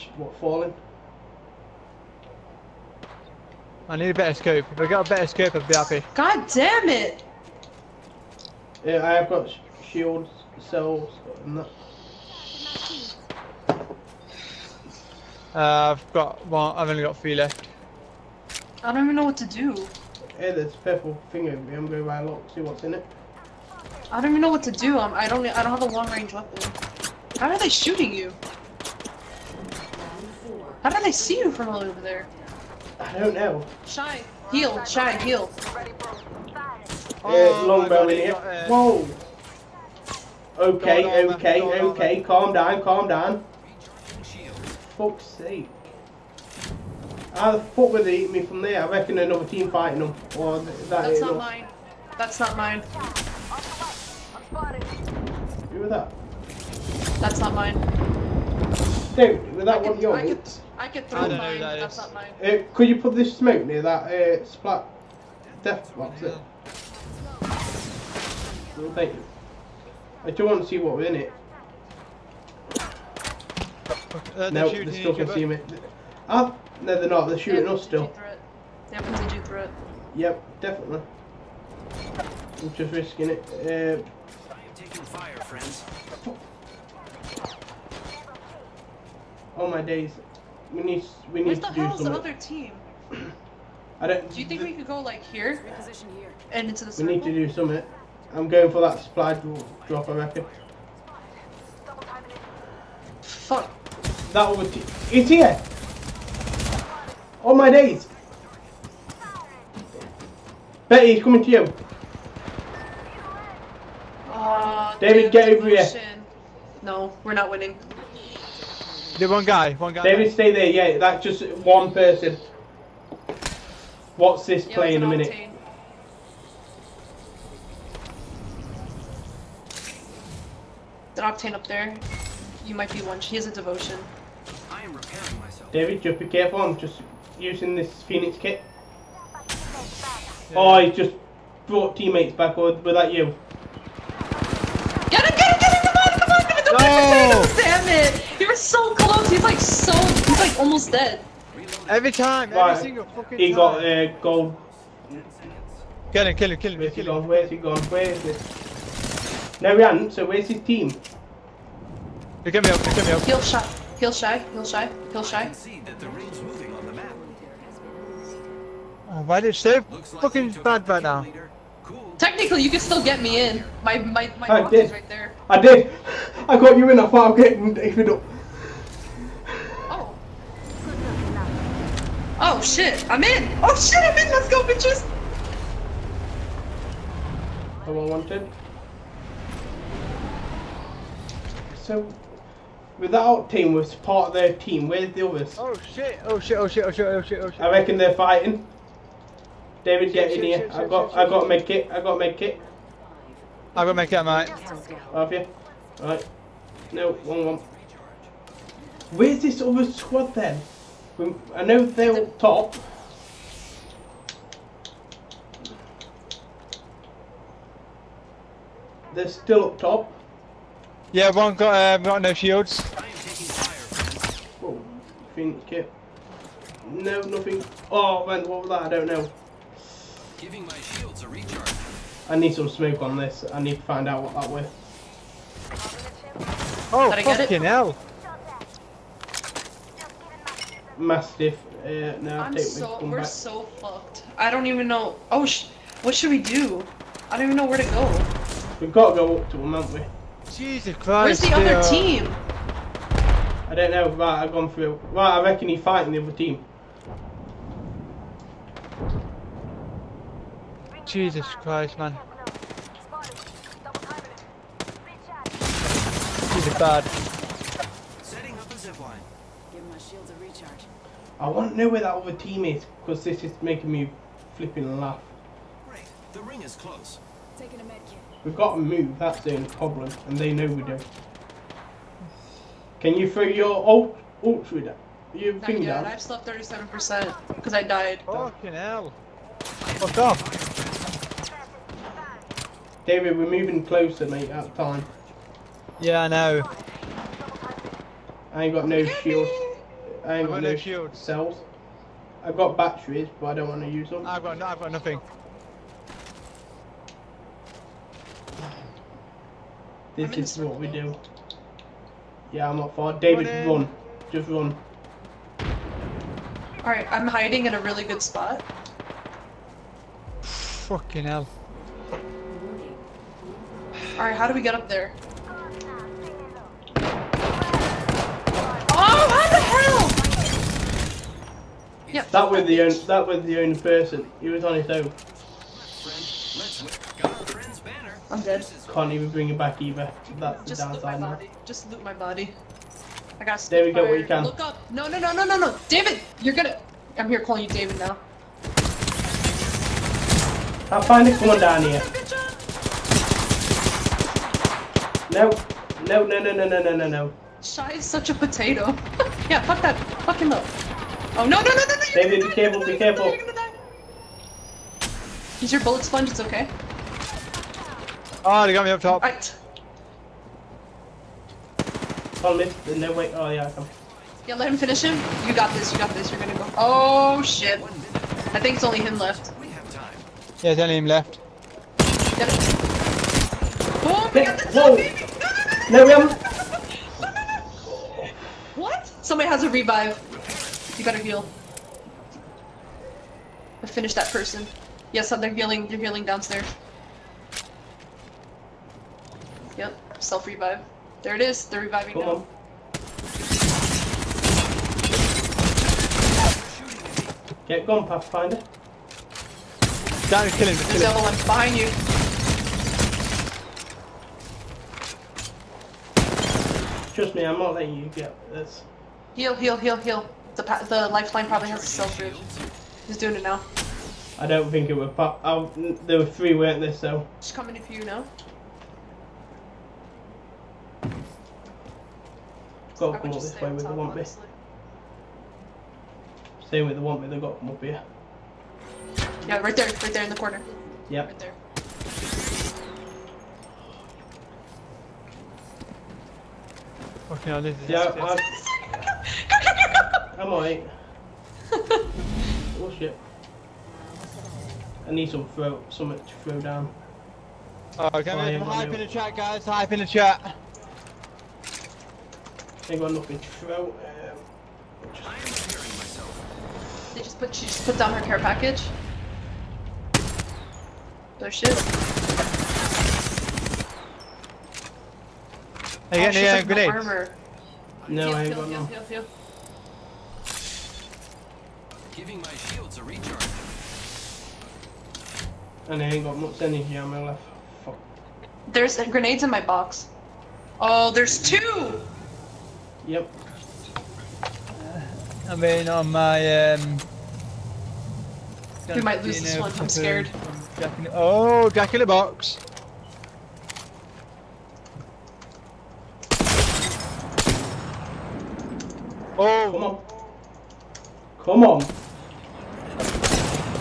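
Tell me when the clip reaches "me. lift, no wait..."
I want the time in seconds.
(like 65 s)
372 s.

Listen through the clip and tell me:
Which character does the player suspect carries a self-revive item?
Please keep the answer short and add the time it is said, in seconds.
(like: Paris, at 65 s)
Lifeline, at 421 s.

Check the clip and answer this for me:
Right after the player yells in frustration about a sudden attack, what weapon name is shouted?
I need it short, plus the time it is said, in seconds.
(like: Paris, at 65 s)
Mastiff, at 240 s.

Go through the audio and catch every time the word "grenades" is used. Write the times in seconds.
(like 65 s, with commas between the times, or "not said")
476 s, 488 s.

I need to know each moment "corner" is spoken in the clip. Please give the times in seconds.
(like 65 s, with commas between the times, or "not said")
440 s.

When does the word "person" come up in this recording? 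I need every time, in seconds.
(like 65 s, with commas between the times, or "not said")
121 s, 333 s, 394 s.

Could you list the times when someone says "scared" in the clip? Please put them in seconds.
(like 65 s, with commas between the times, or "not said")
499 s.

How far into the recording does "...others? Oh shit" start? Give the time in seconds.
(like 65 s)
195 s.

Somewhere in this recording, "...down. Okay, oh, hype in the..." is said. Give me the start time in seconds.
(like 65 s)
456 s.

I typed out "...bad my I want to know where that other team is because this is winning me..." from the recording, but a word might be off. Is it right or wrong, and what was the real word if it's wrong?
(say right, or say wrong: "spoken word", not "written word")
wrong: "making", not "winning".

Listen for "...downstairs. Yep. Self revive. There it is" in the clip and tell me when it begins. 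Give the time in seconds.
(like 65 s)
396 s.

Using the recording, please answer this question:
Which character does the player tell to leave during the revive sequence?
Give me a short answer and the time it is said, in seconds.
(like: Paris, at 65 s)
Pathfinder, at 408 s.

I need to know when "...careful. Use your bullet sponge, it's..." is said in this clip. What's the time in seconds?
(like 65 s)
362 s.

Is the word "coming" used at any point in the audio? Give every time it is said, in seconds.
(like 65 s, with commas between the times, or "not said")
111 s, 427 s.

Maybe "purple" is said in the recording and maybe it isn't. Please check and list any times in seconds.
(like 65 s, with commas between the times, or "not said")
20 s.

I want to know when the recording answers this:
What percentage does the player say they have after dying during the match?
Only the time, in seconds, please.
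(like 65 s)
286 s.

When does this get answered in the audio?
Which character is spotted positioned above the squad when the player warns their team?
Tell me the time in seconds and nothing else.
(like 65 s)
131 s.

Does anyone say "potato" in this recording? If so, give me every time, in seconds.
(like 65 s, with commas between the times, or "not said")
358 s.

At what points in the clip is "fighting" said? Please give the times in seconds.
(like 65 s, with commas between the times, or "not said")
49 s, 198 s, 255 s.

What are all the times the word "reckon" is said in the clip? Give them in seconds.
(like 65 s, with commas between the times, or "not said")
48 s, 100 s, 197 s, 255 s.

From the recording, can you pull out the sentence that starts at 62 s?
Uh, could you put this smoke near that uh, splat death box?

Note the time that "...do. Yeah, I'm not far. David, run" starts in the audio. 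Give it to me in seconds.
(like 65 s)
310 s.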